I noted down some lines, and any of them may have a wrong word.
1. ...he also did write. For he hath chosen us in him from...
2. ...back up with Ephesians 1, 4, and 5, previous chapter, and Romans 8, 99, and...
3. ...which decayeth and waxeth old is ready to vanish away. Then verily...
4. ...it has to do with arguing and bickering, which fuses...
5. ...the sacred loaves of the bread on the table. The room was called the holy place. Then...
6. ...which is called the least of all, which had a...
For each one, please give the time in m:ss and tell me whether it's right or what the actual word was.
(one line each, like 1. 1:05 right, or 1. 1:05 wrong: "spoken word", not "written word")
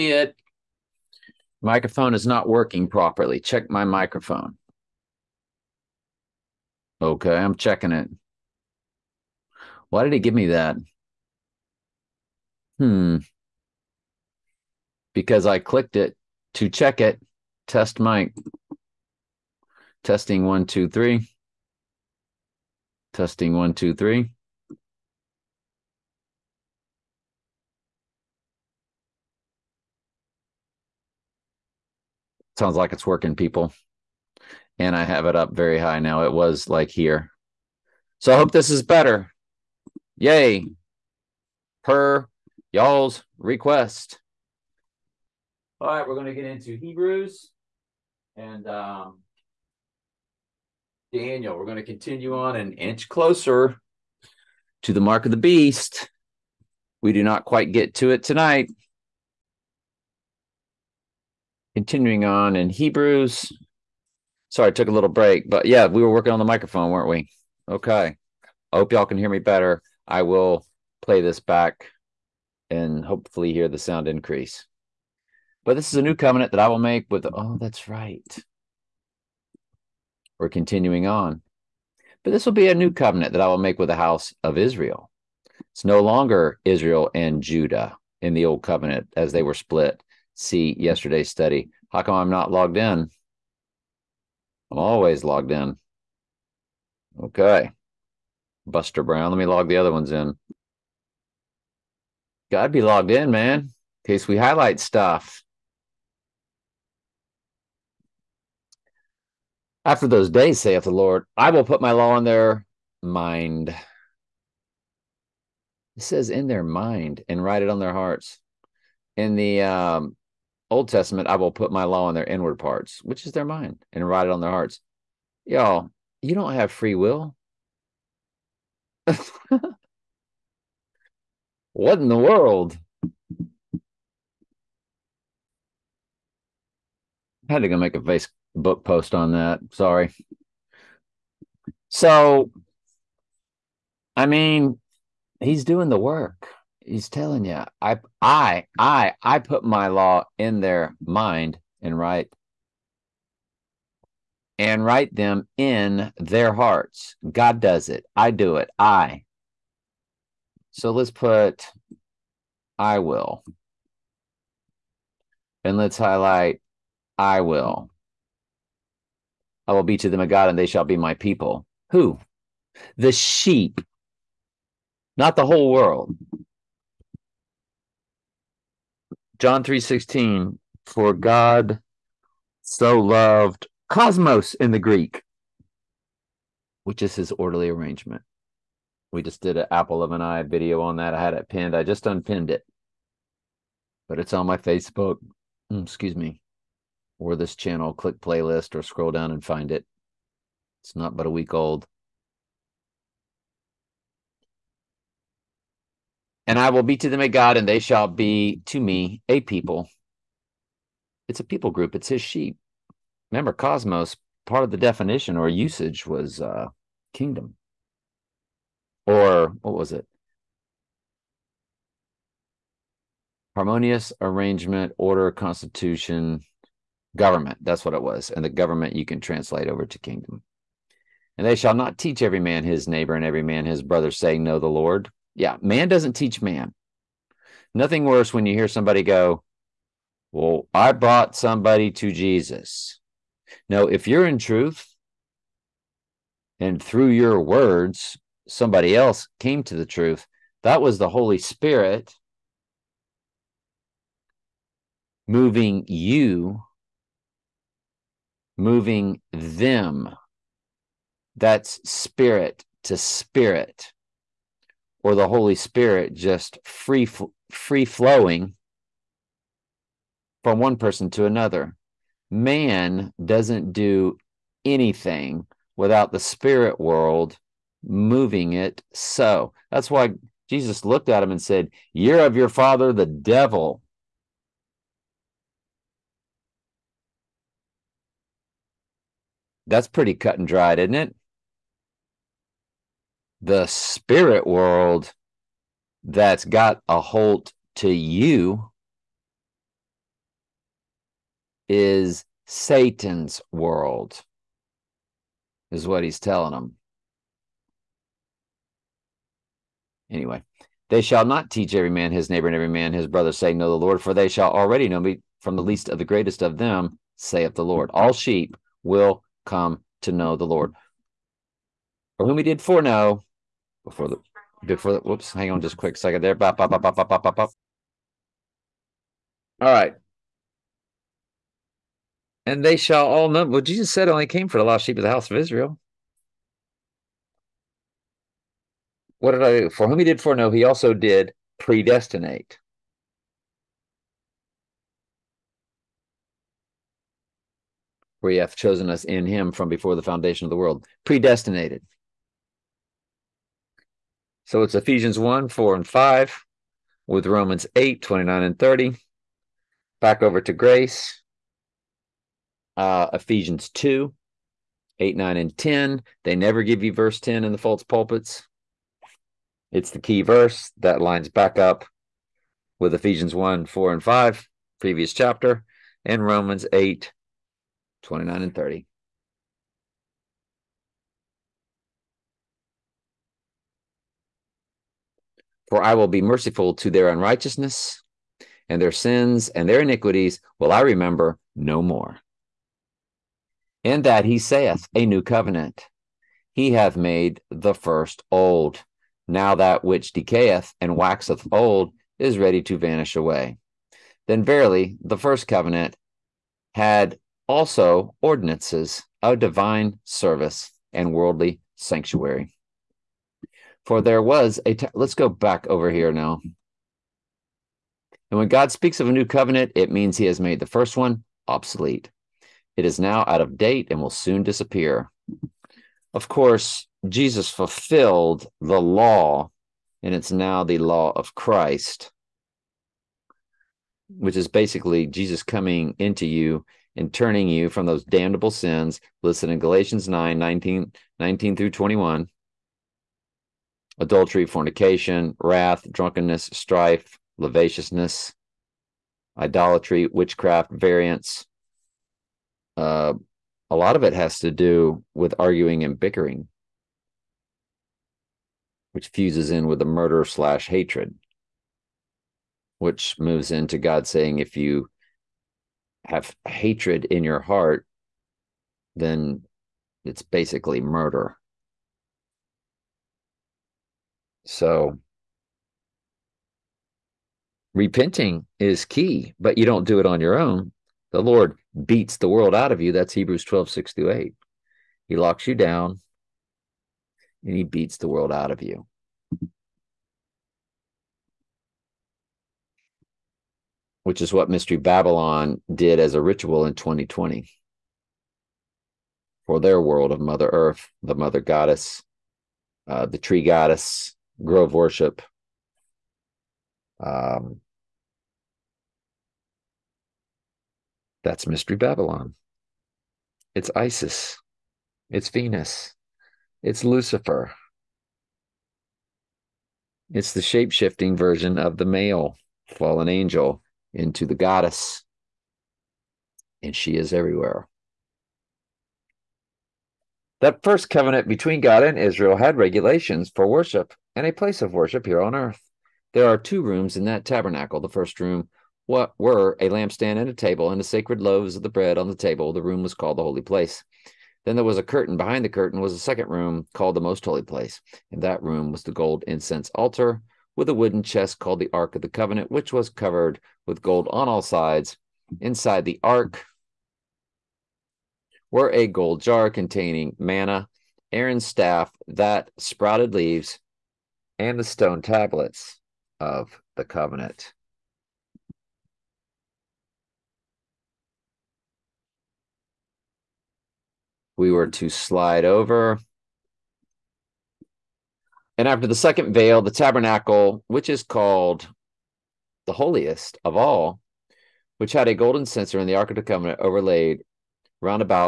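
1. 5:40 wrong: "predestinate", not "write"
2. 6:11 wrong: "29", not "99"
3. 6:39 right
4. 7:34 right
5. 9:00 right
6. 9:40 wrong: "holiest", not "least".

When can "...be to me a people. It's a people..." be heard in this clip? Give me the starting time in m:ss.
3:28.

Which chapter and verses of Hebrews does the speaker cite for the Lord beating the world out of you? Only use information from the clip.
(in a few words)
Hebrews 12:6-8.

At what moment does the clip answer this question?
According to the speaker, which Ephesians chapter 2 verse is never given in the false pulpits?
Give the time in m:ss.
6:06.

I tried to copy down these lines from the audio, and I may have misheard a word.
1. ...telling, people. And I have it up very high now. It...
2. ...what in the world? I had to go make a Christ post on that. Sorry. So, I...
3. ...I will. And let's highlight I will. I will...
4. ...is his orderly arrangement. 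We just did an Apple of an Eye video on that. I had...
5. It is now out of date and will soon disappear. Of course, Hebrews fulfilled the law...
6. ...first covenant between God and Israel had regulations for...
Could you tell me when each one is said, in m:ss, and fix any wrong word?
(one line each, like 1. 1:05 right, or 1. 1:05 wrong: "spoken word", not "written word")
1. 0:33 wrong: "working", not "telling"
2. 2:11 wrong: "Facebook", not "Christ"
3. 2:42 right
4. 3:07 right
5. 7:02 wrong: "Jesus", not "Hebrews"
6. 8:50 right.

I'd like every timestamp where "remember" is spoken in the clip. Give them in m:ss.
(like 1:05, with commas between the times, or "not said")
3:33, 6:30.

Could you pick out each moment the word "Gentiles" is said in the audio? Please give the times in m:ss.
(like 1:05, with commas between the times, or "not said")
not said.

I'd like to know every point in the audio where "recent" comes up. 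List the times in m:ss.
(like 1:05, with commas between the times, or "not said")
not said.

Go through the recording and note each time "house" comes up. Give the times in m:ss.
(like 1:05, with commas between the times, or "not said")
1:23, 5:35.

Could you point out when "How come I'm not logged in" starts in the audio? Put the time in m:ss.
1:31.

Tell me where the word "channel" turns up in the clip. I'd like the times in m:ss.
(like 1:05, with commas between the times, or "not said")
3:17.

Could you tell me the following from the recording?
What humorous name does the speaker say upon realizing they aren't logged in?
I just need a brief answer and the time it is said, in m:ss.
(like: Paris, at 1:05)
Buster Brown, at 1:38.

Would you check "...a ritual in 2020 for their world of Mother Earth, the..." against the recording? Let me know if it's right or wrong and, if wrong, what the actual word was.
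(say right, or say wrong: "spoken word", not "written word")
right.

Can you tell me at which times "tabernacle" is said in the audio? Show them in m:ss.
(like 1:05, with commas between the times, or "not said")
8:57, 9:39.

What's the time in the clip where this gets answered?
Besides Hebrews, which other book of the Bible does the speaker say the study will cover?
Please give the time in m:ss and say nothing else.
0:51.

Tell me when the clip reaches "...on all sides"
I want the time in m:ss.
9:14.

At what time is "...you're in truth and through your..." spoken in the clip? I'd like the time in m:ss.
4:04.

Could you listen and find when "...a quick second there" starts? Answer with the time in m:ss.
5:25.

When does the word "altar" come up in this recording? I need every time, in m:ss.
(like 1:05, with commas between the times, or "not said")
9:09.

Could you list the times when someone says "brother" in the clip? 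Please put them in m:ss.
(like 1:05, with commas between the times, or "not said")
3:53, 5:13.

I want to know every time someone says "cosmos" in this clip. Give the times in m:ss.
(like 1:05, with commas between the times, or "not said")
3:03, 3:33.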